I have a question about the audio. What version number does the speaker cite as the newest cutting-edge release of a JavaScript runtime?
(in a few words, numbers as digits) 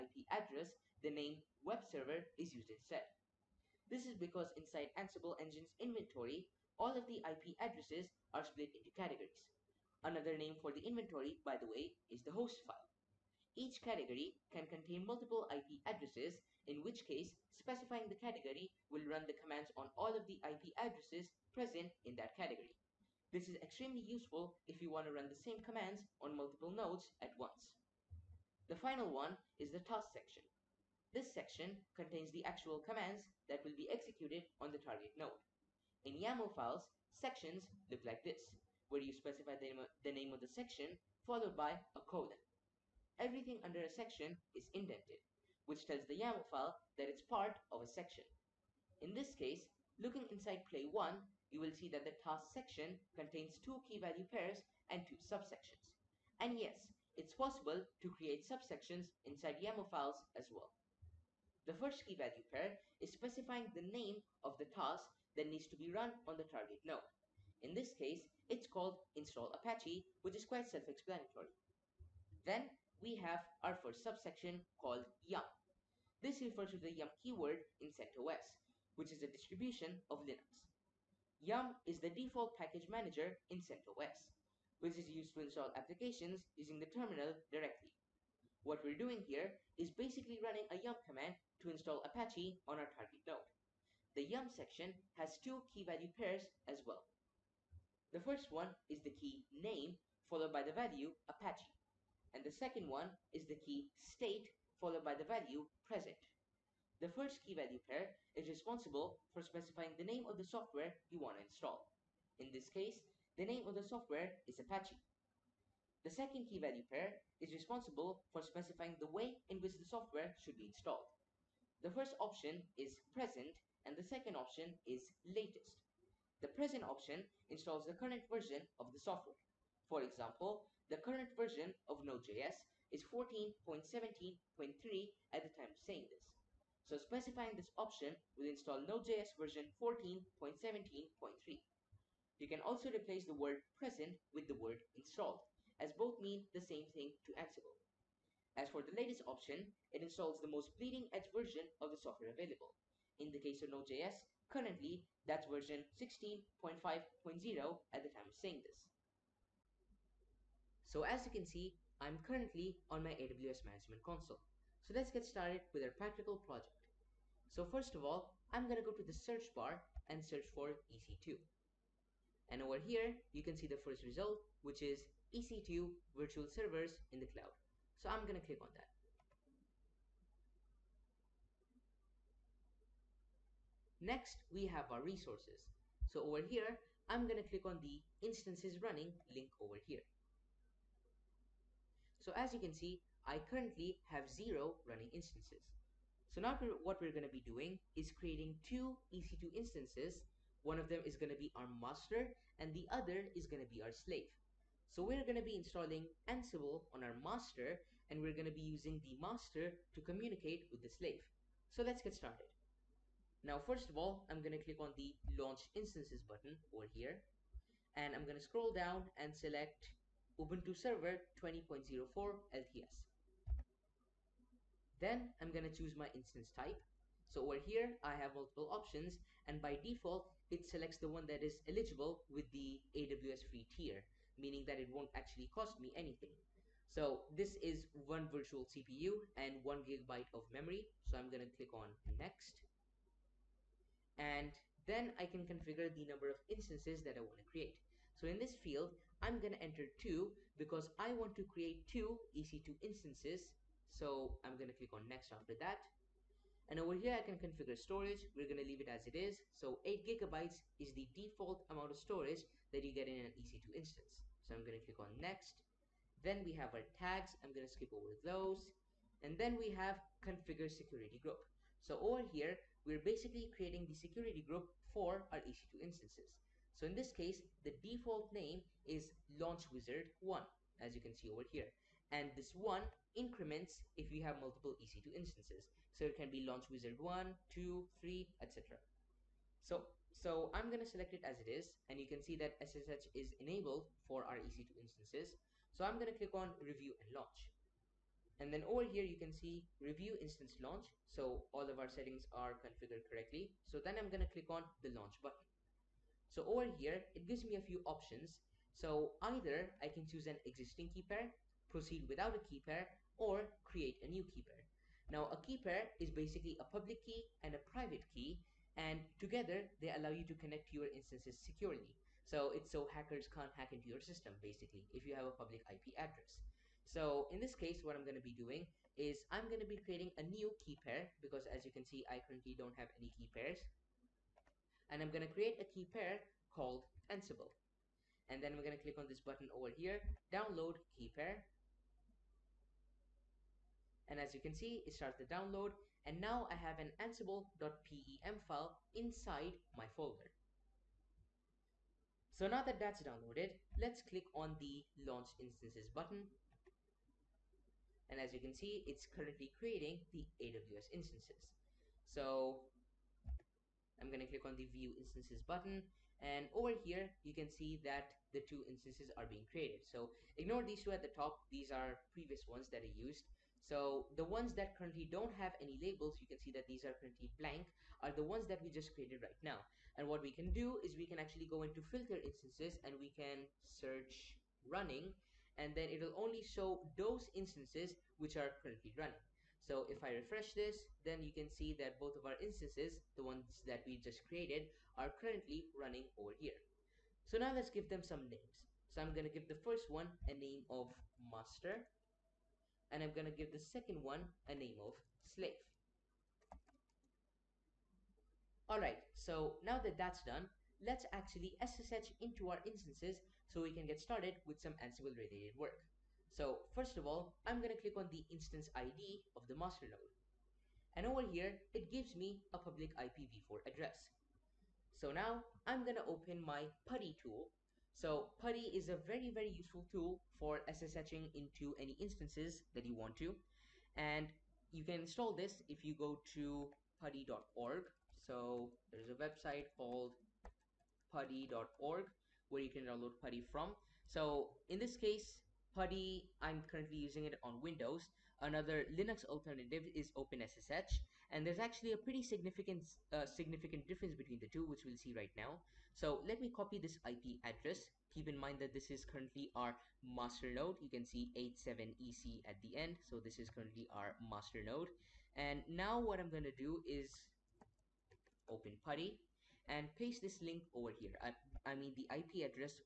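16.5.0.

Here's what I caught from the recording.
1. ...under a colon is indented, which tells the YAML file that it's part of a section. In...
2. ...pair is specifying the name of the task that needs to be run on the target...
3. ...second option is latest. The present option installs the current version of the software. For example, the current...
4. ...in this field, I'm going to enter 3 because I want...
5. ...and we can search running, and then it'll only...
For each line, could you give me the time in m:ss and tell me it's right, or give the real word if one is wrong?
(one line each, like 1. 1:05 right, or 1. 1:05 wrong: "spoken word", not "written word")
1. 0:43 wrong: "section", not "colon"
2. 1:02 right
3. 2:04 right
4. 4:08 wrong: "2", not "3"
5. 6:22 right.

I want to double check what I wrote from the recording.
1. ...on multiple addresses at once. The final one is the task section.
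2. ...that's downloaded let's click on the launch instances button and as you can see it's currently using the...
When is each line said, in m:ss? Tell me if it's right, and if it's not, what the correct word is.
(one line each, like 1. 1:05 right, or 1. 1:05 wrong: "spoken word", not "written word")
1. 0:26 wrong: "nodes", not "addresses"
2. 5:52 wrong: "creating", not "using".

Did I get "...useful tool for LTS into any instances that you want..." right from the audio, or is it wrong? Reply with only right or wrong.
wrong.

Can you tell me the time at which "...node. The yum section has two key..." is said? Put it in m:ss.
1:33.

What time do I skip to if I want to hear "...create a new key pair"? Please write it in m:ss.
5:13.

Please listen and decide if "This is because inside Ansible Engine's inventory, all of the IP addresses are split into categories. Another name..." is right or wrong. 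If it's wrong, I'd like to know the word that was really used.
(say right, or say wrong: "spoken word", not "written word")
right.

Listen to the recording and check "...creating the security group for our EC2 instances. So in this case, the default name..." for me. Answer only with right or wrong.
right.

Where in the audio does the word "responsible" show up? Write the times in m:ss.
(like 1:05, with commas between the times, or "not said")
1:48, 1:57.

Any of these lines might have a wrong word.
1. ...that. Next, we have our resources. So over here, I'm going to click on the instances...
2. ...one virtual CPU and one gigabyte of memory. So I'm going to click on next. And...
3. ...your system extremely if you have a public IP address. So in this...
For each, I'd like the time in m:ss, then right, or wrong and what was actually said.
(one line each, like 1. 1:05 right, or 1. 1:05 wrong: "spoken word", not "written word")
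1. 2:58 right
2. 3:58 right
3. 5:23 wrong: "basically", not "extremely".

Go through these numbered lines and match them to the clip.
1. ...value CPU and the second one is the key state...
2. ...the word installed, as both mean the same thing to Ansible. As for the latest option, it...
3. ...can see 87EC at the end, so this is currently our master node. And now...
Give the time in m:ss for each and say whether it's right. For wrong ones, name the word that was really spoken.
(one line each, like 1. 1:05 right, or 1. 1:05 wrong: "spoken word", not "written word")
1. 1:40 wrong: "Apache", not "CPU"
2. 2:24 right
3. 7:40 right.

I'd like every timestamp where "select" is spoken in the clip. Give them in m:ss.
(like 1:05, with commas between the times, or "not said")
3:39, 3:50, 4:50.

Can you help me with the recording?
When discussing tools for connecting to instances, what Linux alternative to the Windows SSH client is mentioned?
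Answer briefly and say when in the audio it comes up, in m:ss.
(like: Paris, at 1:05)
OpenSSH, at 7:30.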